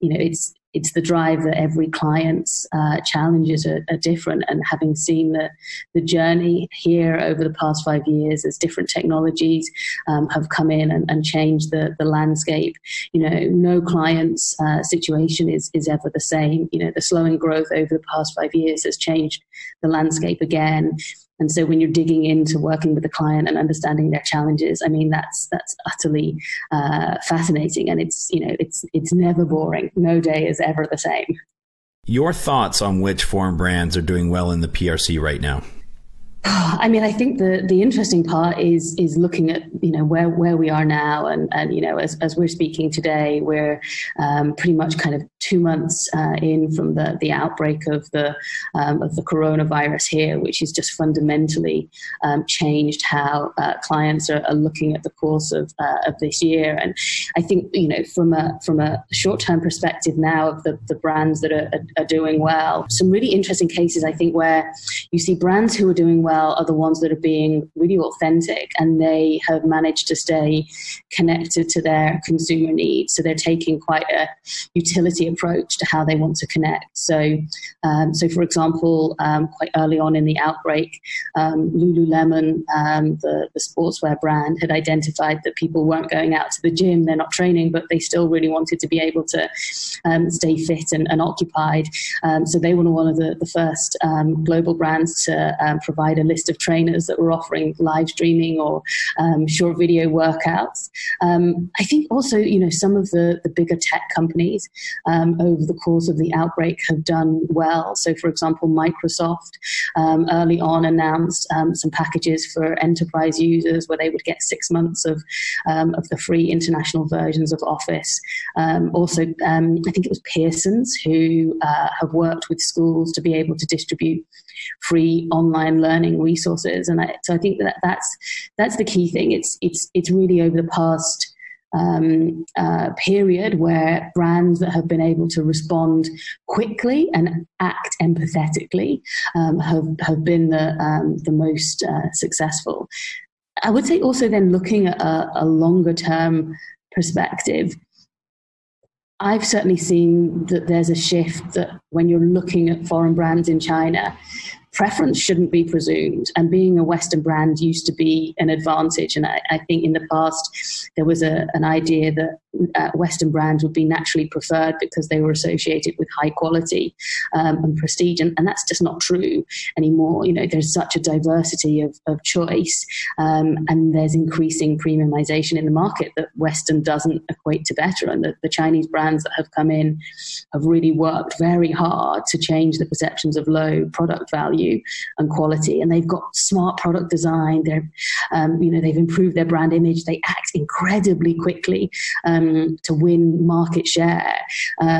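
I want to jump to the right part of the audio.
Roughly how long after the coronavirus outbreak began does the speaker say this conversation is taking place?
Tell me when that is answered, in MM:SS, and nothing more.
00:45.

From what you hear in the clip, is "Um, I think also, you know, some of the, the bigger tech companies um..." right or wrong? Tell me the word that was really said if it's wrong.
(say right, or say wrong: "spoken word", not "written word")
right.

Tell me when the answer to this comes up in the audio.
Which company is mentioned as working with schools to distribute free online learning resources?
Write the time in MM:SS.
02:00.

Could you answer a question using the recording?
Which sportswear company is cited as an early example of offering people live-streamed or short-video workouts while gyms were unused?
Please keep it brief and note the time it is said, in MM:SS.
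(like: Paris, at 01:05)
Lululemon, at 01:21.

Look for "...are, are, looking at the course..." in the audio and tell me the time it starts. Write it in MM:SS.
00:54.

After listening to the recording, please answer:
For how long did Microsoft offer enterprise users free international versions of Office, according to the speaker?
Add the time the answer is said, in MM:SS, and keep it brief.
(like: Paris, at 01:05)
6 months, at 01:54.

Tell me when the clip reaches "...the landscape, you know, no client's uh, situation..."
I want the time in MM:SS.
00:11.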